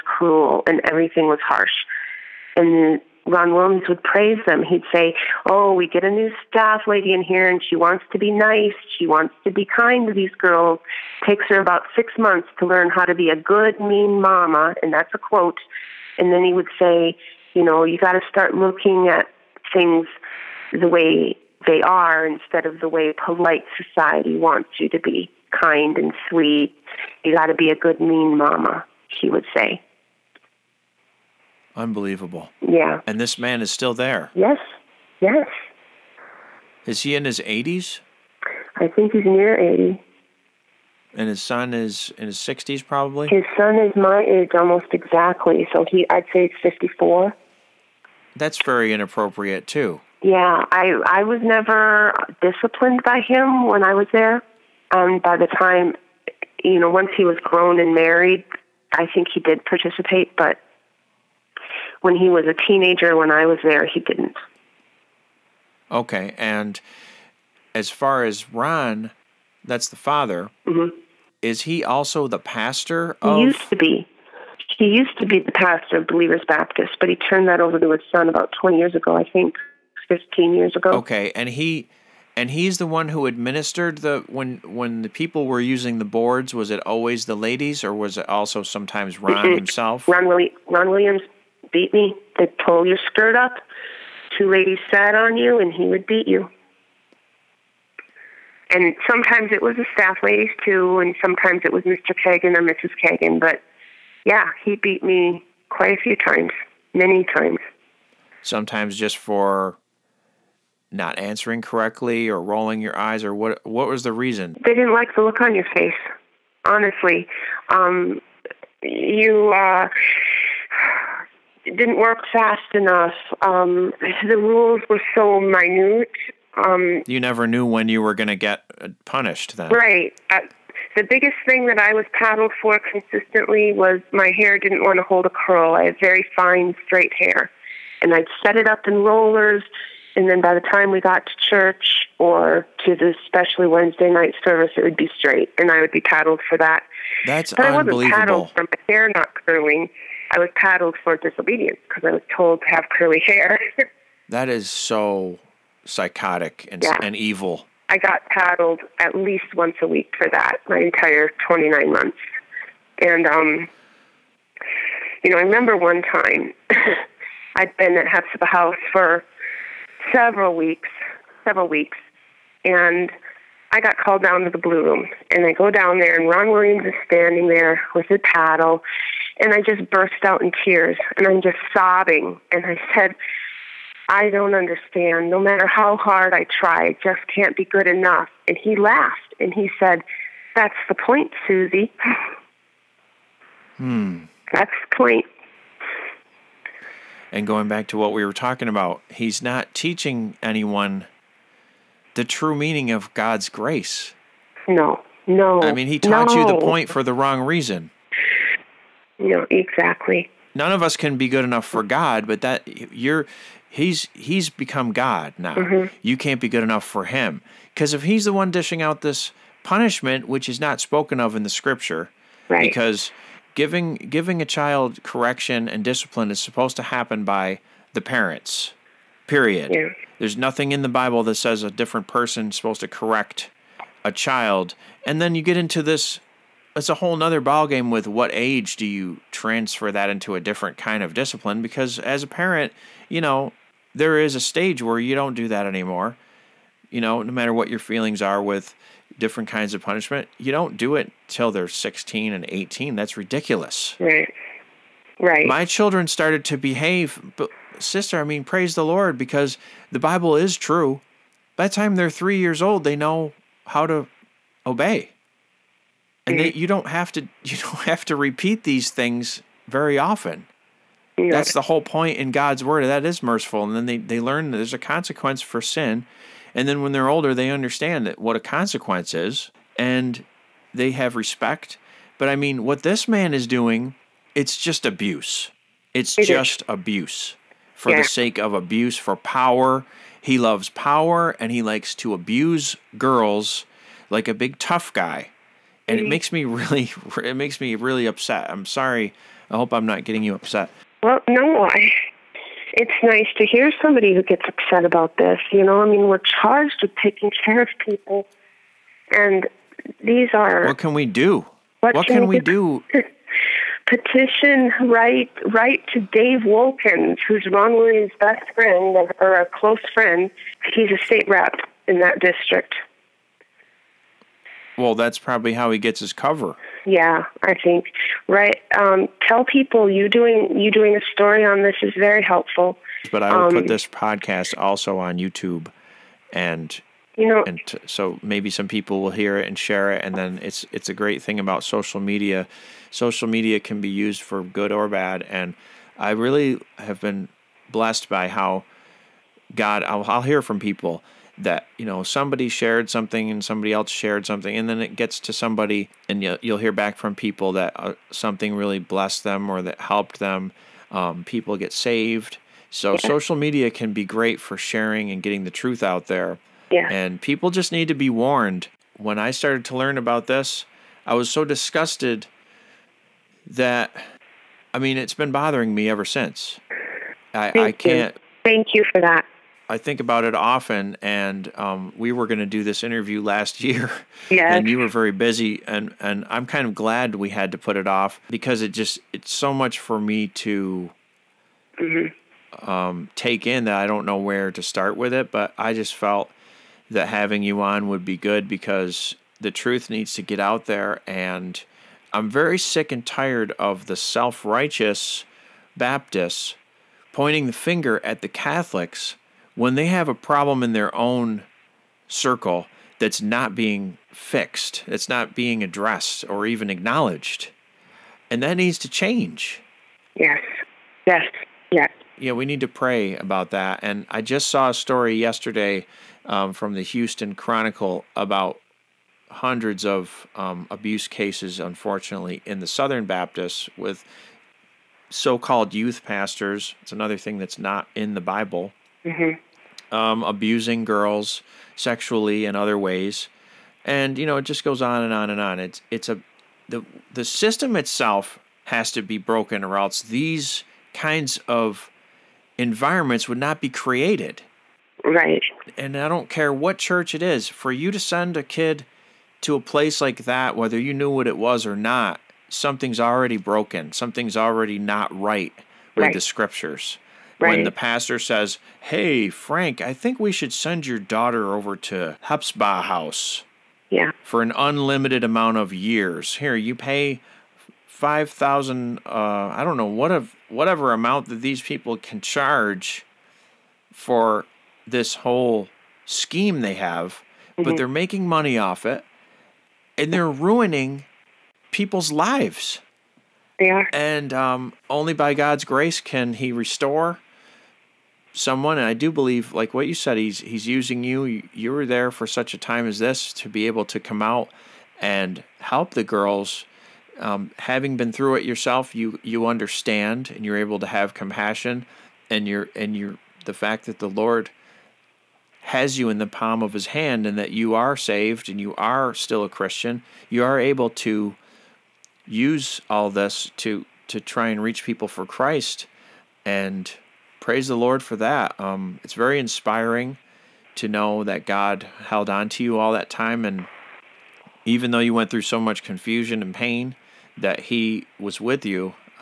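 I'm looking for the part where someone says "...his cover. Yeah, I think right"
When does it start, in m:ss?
5:26.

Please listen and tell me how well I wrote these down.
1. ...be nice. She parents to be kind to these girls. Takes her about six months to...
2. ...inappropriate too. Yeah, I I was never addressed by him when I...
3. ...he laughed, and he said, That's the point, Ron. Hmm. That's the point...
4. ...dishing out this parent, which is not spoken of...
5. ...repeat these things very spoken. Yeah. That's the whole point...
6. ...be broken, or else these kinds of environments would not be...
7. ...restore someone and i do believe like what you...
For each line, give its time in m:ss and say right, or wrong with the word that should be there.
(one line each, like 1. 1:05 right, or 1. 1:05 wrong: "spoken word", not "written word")
1. 0:08 wrong: "wants", not "parents"
2. 0:48 wrong: "disciplined", not "addressed"
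3. 3:08 wrong: "Susie", not "Ron"
4. 3:38 wrong: "punishment", not "parent"
5. 4:28 wrong: "often", not "spoken"
6. 7:29 right
7. 8:16 right.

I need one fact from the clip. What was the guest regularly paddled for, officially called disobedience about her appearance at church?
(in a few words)
hair not curling.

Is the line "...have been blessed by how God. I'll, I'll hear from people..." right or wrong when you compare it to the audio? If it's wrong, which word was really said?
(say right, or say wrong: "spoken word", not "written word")
right.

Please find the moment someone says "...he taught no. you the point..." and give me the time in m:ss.
3:25.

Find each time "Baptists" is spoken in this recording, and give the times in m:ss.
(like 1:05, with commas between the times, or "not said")
1:16, 6:45, 7:13.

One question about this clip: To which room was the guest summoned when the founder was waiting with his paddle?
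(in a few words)
the blue room.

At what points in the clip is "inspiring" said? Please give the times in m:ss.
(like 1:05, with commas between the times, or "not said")
8:49.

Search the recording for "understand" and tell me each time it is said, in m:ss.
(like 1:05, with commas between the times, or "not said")
3:04, 4:37, 8:29.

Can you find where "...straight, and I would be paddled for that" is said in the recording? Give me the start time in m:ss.
2:25.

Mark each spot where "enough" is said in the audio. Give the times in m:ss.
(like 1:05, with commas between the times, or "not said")
2:02, 3:07, 3:31, 3:36.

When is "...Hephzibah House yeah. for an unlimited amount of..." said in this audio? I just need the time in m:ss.
7:52.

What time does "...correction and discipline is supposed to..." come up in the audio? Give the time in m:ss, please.
3:45.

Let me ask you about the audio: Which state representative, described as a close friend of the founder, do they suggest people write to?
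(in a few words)
Dave Wolkins.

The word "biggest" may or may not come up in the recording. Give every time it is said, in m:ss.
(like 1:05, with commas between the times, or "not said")
2:11.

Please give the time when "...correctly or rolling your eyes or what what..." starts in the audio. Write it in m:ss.
1:51.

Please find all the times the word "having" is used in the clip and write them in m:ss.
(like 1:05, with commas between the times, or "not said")
6:37, 8:27.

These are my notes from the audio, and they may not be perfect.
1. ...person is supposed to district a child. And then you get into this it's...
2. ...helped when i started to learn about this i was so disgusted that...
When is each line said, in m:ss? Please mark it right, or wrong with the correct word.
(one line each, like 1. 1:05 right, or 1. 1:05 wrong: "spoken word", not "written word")
1. 3:52 wrong: "correct", not "district"
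2. 6:08 wrong: "warned", not "helped".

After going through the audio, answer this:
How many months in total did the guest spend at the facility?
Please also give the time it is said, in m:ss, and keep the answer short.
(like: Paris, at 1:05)
29, at 2:41.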